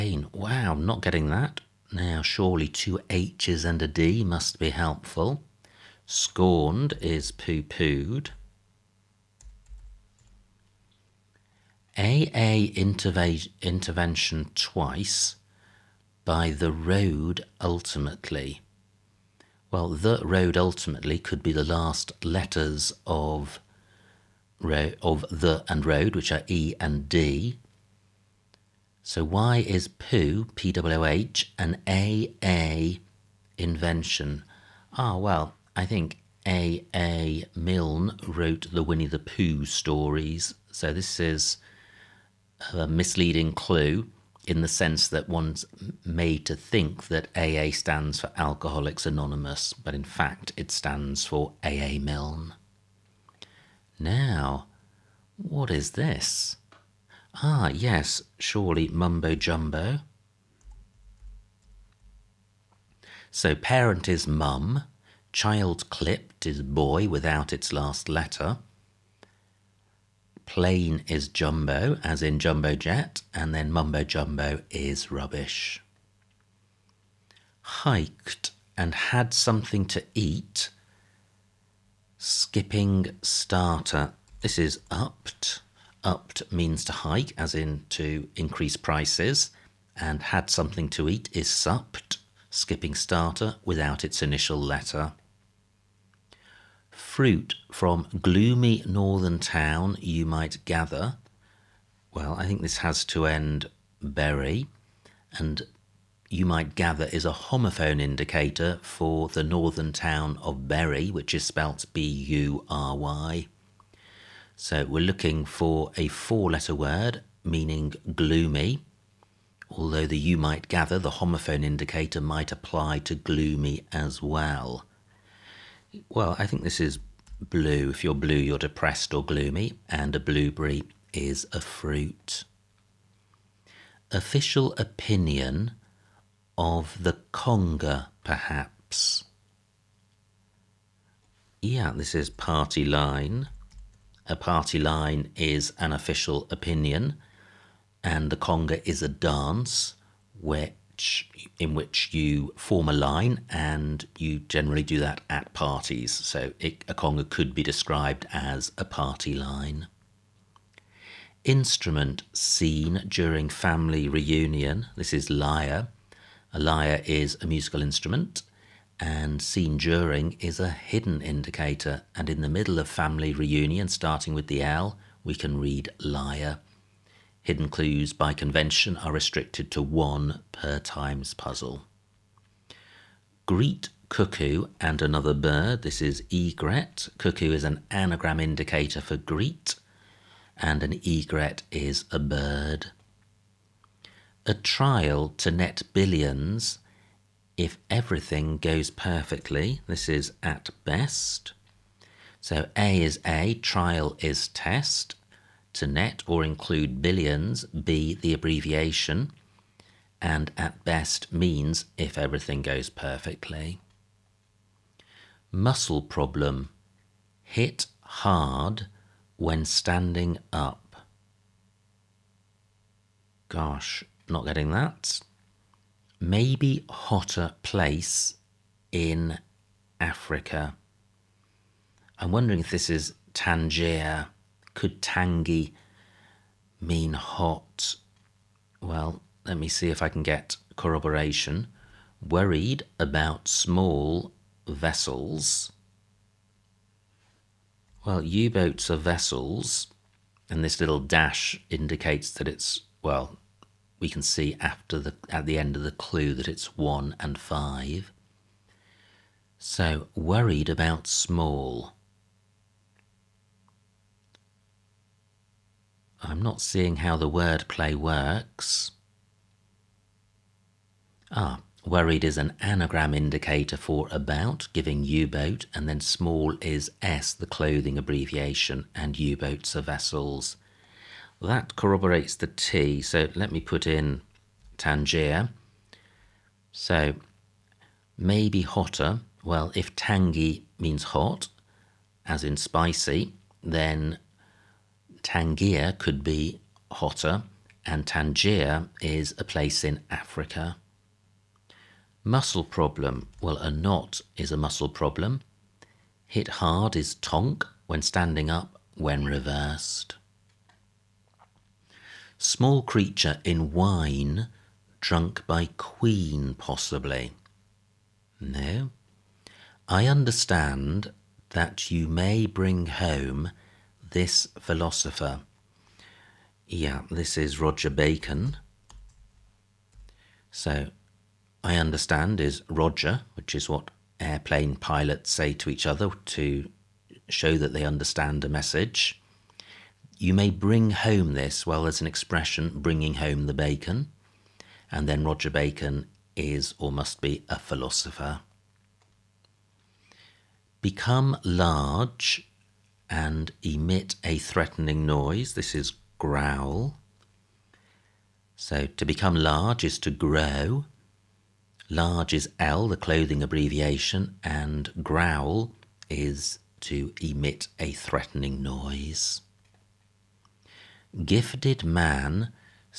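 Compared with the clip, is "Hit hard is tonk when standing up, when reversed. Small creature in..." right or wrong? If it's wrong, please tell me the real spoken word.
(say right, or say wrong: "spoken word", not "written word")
right.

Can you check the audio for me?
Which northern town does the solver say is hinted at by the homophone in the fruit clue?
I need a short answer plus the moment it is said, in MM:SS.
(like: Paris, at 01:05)
Bury, at 01:50.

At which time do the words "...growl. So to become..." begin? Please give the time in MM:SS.
05:56.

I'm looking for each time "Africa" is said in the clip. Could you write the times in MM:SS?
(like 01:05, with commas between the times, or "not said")
03:49, 05:00.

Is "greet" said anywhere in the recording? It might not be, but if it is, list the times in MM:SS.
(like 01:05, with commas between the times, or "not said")
03:03, 03:09.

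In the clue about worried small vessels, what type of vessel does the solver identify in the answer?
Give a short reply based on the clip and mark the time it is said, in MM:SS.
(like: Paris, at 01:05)
U-boats, at 04:08.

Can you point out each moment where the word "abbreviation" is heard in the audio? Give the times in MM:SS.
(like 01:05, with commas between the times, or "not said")
03:28, 04:37, 06:03.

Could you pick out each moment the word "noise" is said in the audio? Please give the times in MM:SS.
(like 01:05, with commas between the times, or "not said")
05:55, 06:08.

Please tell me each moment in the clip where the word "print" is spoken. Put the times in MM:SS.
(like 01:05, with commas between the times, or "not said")
not said.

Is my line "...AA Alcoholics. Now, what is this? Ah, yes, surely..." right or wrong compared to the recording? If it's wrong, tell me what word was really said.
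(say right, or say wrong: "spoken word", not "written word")
wrong: "Milne", not "Alcoholics".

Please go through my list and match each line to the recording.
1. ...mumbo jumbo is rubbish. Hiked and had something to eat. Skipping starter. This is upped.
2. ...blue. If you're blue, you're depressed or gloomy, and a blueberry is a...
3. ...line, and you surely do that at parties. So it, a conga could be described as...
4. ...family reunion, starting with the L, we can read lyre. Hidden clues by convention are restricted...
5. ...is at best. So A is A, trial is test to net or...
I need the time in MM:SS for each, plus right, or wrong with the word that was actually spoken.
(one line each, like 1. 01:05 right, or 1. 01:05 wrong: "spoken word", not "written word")
1. 01:13 right
2. 02:07 right
3. 02:32 wrong: "generally", not "surely"
4. 02:52 right
5. 03:20 right.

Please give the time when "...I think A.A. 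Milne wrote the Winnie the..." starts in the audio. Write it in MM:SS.
00:35.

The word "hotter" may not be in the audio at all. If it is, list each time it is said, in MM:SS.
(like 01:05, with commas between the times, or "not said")
03:46, 04:48, 04:56.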